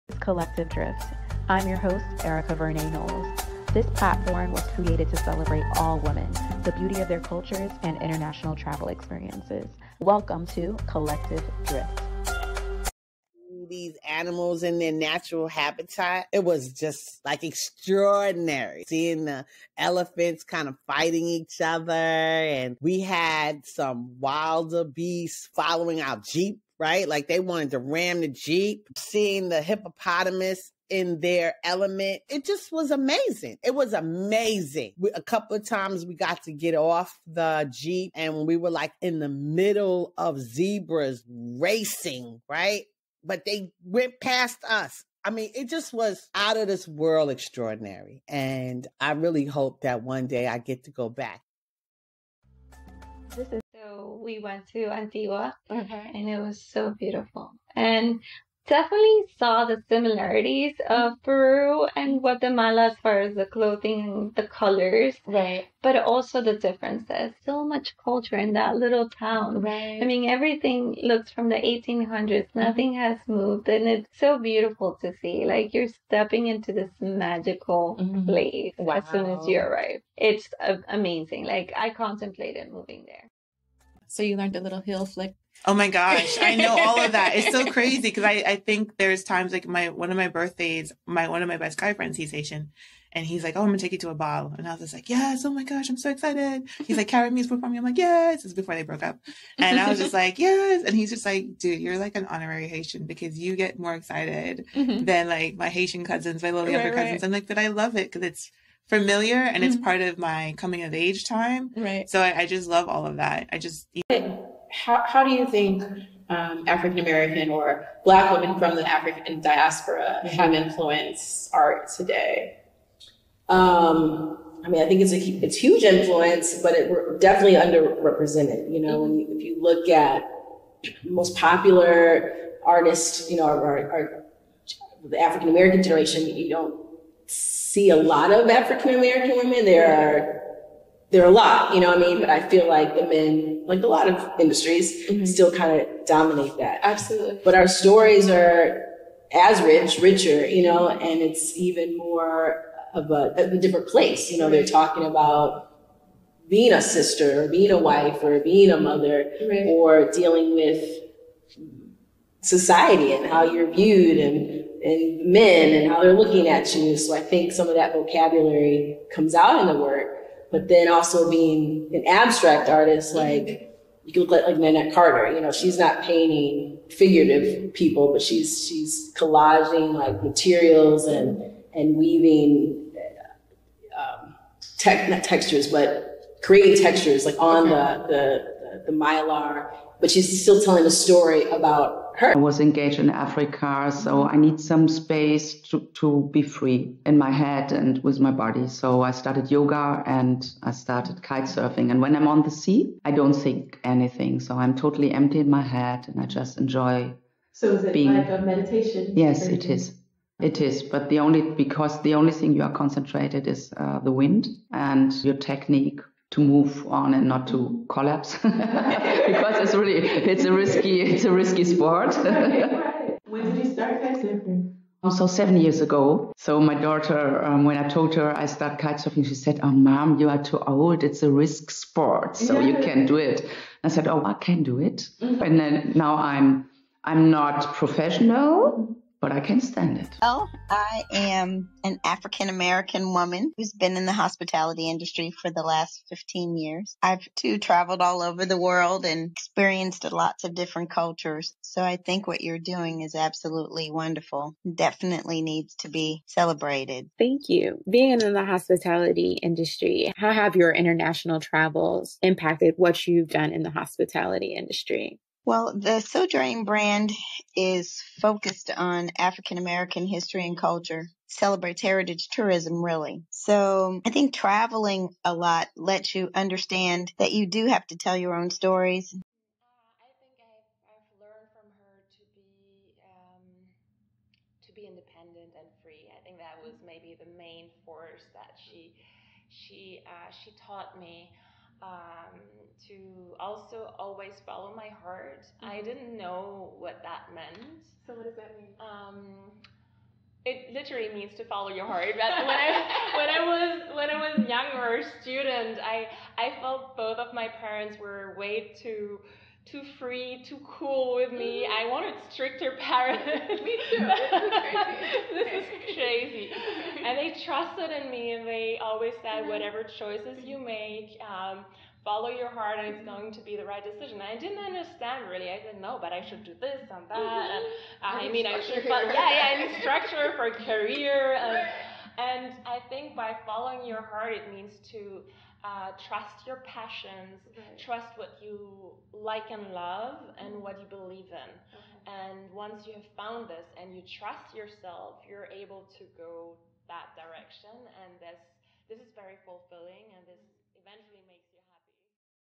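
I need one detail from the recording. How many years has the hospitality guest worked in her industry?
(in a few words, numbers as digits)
15 years.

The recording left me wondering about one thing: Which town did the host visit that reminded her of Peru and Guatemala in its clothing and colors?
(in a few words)
Antigua.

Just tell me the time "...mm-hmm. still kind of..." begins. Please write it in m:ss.
2:25.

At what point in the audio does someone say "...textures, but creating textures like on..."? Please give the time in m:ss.
3:05.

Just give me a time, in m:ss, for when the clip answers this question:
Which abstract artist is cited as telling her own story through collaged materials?
2:54.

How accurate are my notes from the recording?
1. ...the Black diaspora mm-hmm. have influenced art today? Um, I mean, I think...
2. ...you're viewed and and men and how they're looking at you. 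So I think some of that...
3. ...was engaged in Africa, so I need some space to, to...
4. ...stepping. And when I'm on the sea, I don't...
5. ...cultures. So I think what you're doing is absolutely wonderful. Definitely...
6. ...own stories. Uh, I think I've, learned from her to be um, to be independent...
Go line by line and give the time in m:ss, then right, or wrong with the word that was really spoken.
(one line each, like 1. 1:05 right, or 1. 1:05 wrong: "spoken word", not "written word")
1. 1:58 wrong: "African", not "Black"
2. 2:43 right
3. 3:12 right
4. 3:21 wrong: "surfing", not "stepping"
5. 4:10 right
6. 4:38 right.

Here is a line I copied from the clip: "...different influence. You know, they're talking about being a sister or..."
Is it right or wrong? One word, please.
wrong.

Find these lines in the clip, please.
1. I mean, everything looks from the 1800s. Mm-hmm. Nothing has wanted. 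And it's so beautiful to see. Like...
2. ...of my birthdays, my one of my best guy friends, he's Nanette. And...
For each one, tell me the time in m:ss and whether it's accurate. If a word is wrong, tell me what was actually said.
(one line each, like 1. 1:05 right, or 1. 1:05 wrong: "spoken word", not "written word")
1. 1:10 wrong: "moved", not "wanted"
2. 1:30 wrong: "Haitian", not "Nanette".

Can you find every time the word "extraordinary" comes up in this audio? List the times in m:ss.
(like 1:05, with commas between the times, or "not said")
0:17, 0:47.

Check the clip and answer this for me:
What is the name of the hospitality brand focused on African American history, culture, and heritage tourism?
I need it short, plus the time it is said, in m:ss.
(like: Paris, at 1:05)
Sojourn, at 4:26.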